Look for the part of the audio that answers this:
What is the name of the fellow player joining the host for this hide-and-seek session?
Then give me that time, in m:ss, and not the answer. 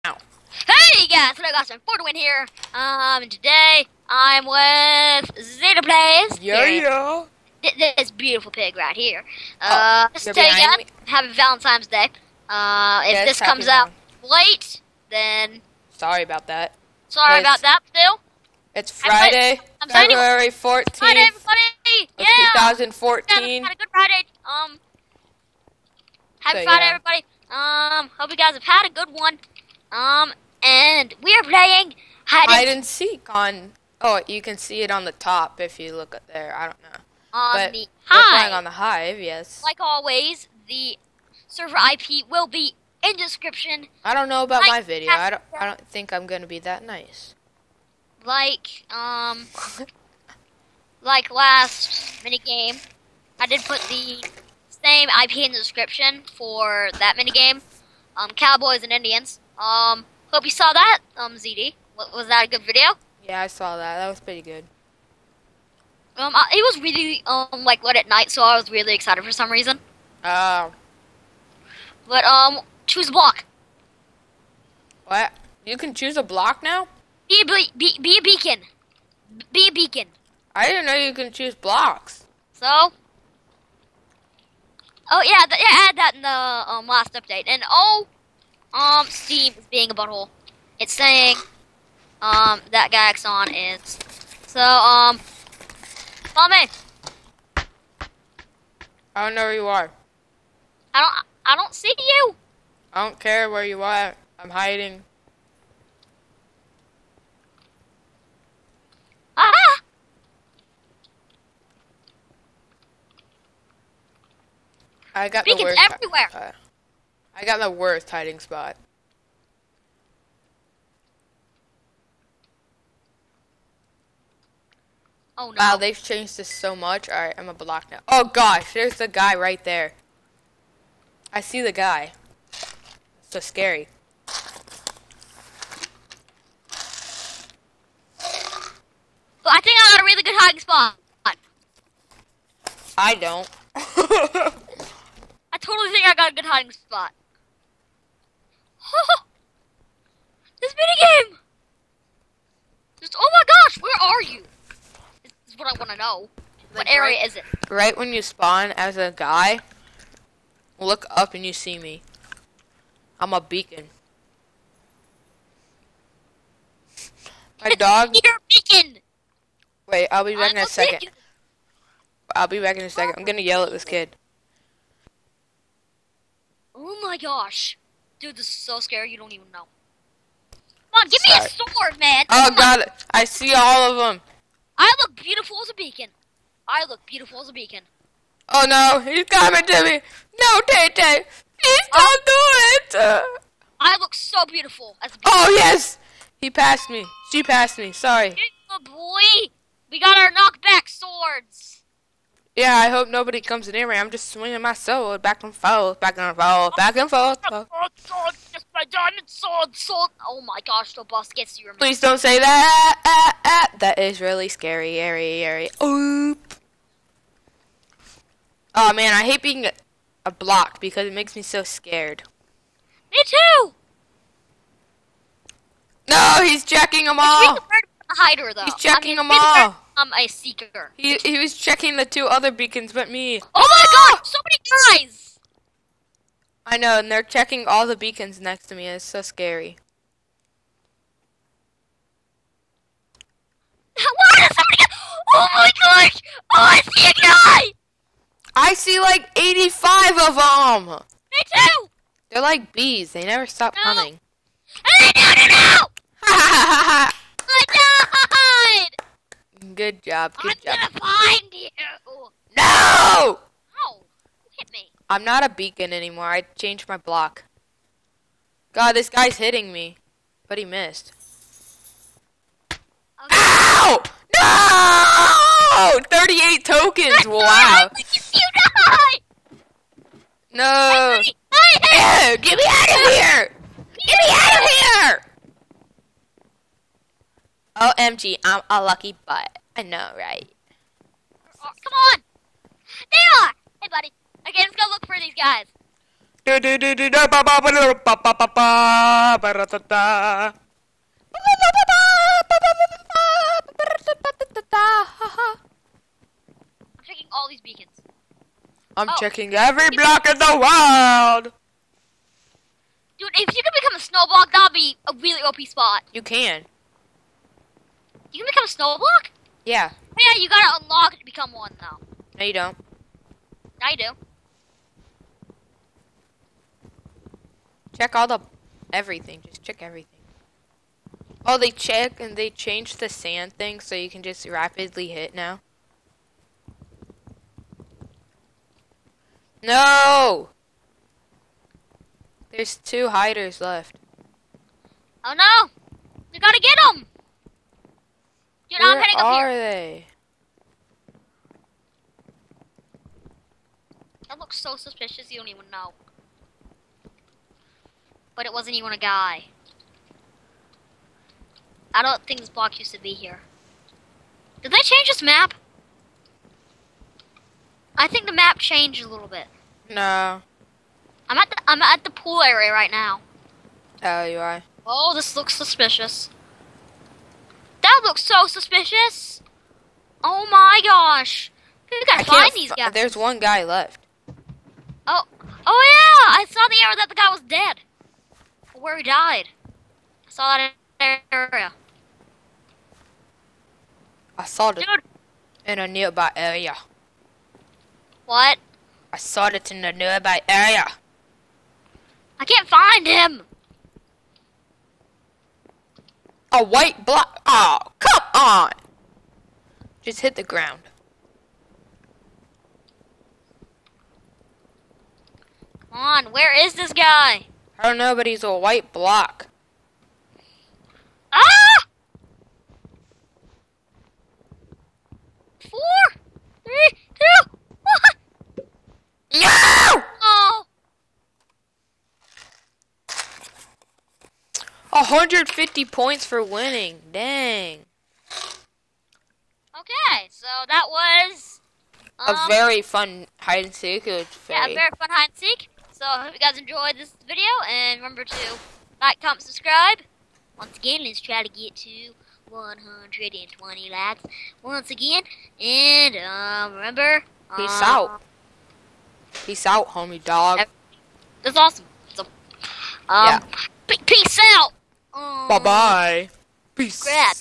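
0:05.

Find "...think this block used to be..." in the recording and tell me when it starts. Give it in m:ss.
6:02.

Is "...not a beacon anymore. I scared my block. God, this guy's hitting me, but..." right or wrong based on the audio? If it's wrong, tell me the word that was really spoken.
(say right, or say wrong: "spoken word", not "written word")
wrong: "changed", not "scared".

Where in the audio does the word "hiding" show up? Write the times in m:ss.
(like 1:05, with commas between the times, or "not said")
1:44, 1:58, 2:20, 2:26.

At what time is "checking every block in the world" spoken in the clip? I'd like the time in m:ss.
5:09.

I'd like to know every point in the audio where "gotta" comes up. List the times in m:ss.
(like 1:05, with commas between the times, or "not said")
5:20, 5:46, 6:22.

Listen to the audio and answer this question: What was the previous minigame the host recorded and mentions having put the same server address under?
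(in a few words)
Cowboys and Indians.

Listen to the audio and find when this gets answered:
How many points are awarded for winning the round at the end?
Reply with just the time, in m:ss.
7:15.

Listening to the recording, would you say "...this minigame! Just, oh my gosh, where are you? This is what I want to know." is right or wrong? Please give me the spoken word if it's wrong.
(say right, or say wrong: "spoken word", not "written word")
right.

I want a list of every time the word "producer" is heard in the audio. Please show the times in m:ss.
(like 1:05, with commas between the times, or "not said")
not said.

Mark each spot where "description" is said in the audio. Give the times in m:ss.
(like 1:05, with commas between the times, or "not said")
0:43, 0:55.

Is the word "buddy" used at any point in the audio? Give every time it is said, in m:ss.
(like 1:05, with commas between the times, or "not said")
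4:53.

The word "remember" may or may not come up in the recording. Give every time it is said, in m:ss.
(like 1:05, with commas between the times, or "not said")
7:27, 7:36.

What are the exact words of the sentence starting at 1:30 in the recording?
It's saying, um, that Gaxon is.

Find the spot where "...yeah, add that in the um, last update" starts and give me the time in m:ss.
1:25.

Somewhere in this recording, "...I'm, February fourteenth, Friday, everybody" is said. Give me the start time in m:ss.
0:19.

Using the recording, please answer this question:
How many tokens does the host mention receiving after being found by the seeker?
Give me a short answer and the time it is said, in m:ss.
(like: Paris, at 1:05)
38, at 4:36.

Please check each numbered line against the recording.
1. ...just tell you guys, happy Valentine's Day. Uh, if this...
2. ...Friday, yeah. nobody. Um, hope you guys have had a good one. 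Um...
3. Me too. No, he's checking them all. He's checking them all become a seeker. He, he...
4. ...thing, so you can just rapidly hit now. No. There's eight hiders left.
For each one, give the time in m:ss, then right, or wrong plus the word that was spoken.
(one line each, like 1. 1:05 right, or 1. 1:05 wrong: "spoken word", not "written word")
1. 0:10 right
2. 0:26 wrong: "everybody", not "nobody"
3. 3:43 right
4. 5:33 wrong: "two", not "eight".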